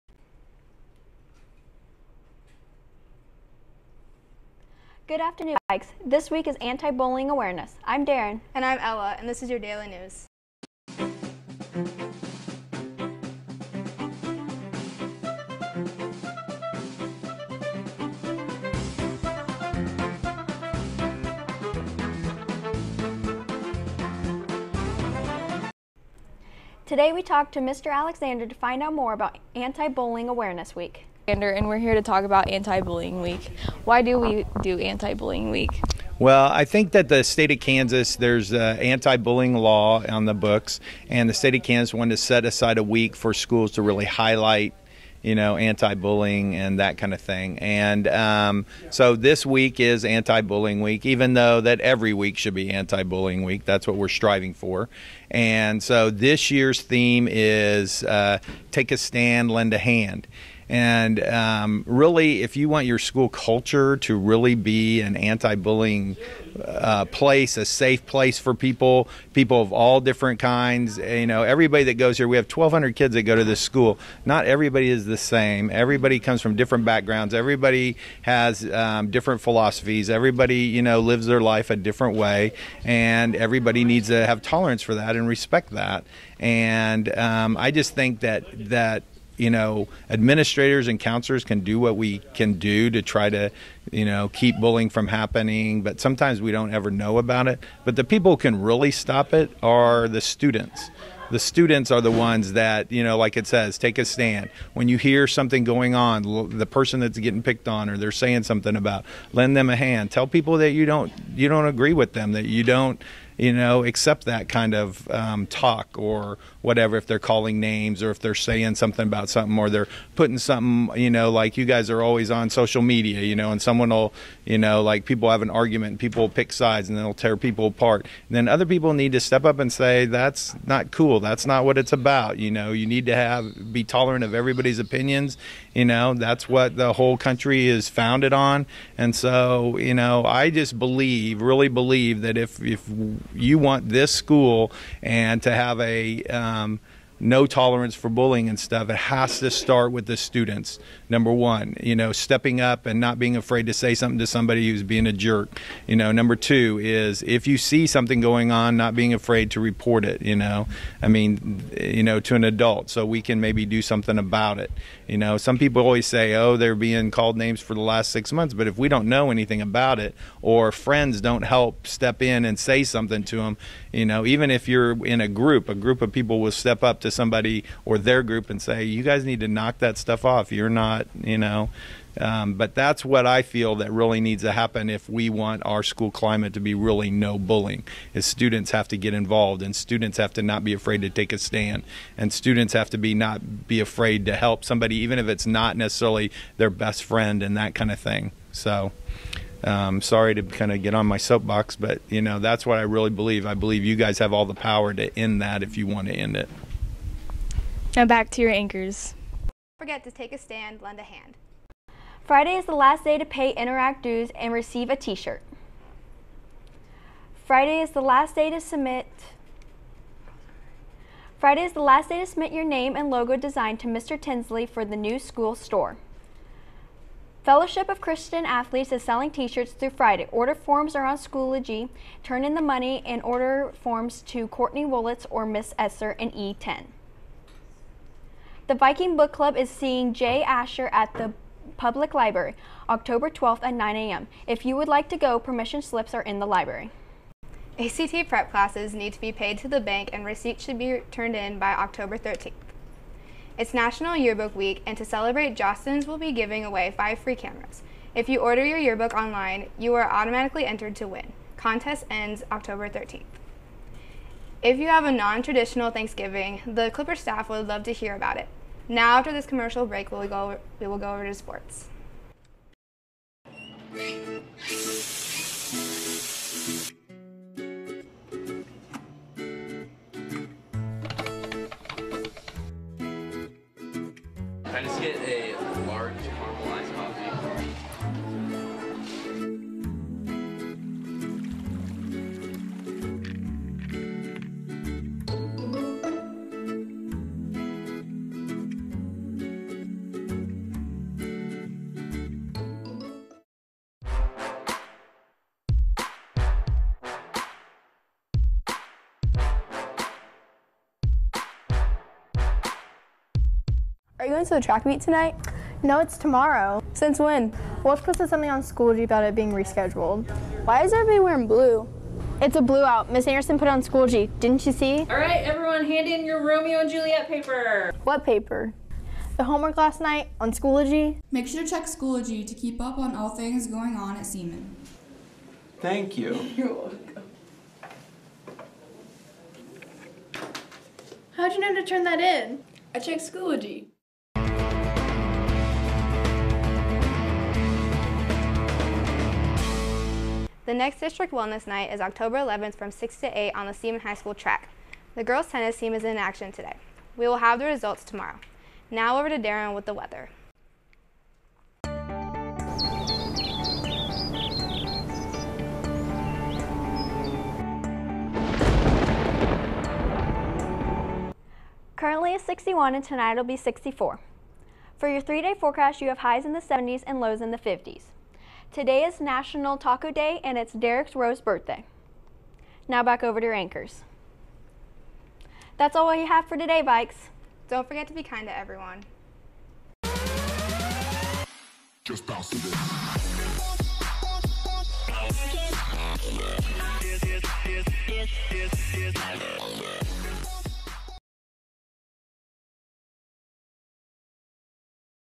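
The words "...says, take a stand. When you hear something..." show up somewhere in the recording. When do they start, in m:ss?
1:43.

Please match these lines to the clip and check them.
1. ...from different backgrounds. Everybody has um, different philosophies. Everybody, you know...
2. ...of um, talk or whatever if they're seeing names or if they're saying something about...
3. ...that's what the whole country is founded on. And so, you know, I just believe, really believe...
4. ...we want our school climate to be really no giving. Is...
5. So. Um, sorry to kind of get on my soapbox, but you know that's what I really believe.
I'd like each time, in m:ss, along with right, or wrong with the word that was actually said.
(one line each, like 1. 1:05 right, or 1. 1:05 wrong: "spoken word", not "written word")
1. 1:16 right
2. 1:54 wrong: "calling", not "seeing"
3. 2:16 right
4. 3:05 wrong: "bullying", not "giving"
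5. 3:18 right.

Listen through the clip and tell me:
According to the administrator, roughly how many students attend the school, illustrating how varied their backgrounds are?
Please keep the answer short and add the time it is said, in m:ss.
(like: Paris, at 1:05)
1,200, at 1:12.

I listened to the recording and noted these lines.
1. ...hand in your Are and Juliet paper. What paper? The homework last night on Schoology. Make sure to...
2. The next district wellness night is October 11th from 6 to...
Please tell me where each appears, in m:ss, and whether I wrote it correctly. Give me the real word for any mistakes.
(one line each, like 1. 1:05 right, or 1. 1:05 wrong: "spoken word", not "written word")
1. 5:25 wrong: "Romeo", not "Are"
2. 5:50 right.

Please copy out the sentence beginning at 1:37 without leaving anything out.
But the people who can really stop it are the students.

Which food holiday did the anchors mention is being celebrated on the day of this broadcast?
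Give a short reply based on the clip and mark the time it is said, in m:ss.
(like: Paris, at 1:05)
National Taco Day, at 6:19.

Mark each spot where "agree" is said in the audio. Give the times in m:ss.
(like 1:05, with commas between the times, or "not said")
1:51.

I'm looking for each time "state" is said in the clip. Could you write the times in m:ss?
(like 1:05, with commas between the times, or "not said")
0:37, 0:41.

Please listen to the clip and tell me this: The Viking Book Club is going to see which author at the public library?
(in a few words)
Jay Asher.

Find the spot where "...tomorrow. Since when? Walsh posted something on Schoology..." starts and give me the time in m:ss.
5:16.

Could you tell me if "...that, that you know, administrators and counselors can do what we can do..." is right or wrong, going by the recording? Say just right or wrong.
right.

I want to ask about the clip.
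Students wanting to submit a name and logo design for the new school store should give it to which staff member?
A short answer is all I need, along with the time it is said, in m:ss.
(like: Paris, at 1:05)
Mr. Tinsley, at 3:43.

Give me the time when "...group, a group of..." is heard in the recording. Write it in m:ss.
2:55.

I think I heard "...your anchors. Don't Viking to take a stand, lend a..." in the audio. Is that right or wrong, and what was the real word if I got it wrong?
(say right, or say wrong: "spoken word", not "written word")
wrong: "Forget", not "Viking".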